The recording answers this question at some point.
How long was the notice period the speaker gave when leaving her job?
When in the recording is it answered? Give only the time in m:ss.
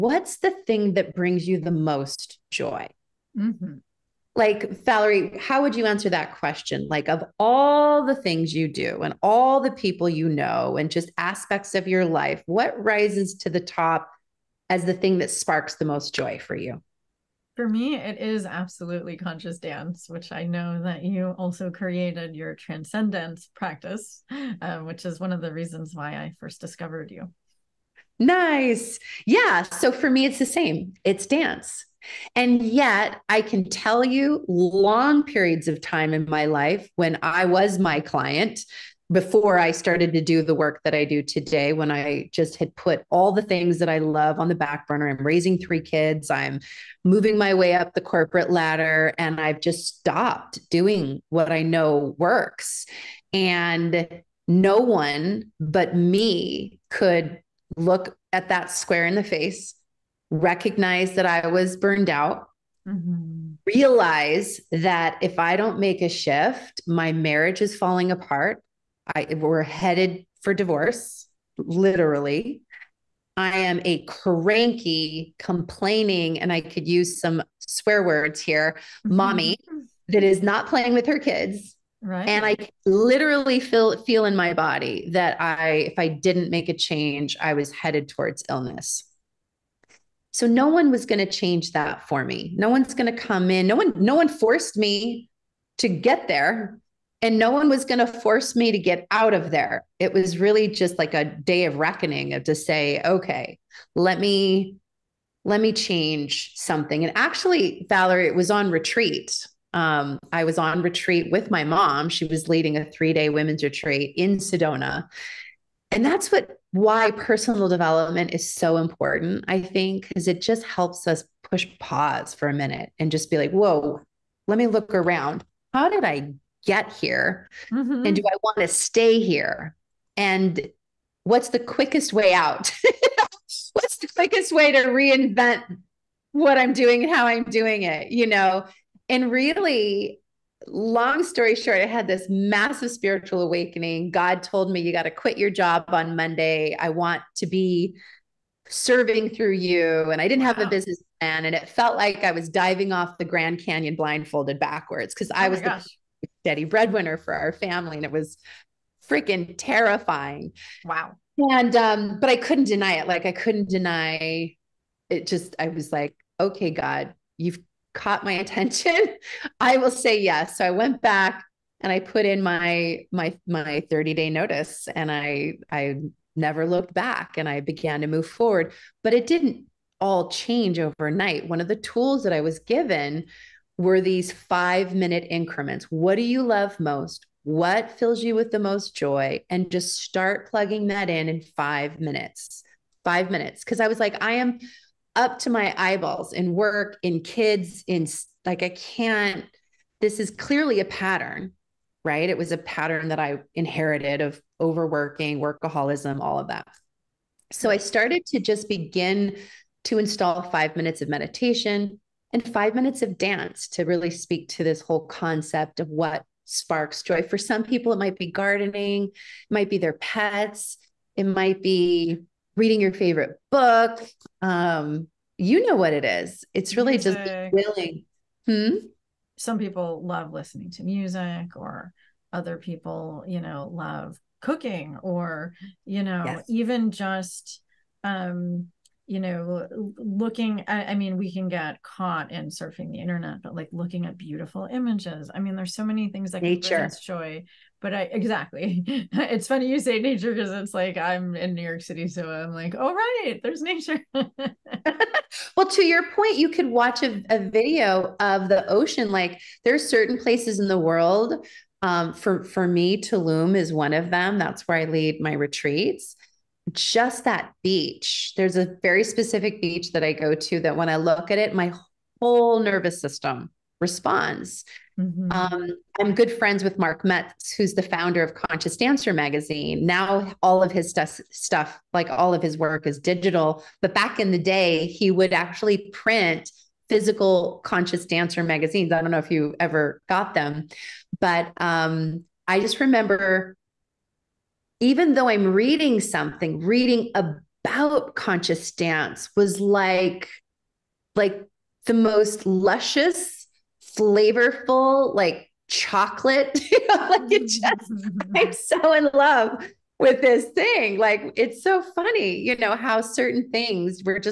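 2:53.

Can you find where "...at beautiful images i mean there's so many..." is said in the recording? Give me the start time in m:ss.
4:04.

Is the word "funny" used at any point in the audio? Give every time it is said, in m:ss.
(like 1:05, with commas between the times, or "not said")
4:09, 5:11.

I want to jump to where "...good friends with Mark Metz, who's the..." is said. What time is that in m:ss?
4:36.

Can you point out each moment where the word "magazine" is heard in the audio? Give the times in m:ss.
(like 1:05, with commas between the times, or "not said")
4:39, 4:48.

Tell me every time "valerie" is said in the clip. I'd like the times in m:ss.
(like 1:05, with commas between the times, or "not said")
0:04, 1:47.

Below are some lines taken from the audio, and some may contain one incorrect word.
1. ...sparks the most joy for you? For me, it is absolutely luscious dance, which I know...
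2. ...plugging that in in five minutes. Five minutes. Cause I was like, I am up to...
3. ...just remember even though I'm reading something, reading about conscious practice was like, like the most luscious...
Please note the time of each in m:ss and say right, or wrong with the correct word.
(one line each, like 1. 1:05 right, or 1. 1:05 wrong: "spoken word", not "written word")
1. 0:15 wrong: "conscious", not "luscious"
2. 3:10 right
3. 4:52 wrong: "dance", not "practice".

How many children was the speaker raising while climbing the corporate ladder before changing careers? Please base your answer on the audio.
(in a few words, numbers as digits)
3.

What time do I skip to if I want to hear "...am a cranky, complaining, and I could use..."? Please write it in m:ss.
1:13.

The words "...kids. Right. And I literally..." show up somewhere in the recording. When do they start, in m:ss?
1:21.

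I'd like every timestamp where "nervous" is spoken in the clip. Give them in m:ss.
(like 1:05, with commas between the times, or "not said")
4:32.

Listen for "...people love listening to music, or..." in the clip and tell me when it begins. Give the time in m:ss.
3:49.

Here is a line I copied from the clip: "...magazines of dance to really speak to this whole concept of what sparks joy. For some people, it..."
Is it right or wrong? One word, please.
wrong.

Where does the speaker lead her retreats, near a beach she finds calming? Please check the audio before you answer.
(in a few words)
Tulum.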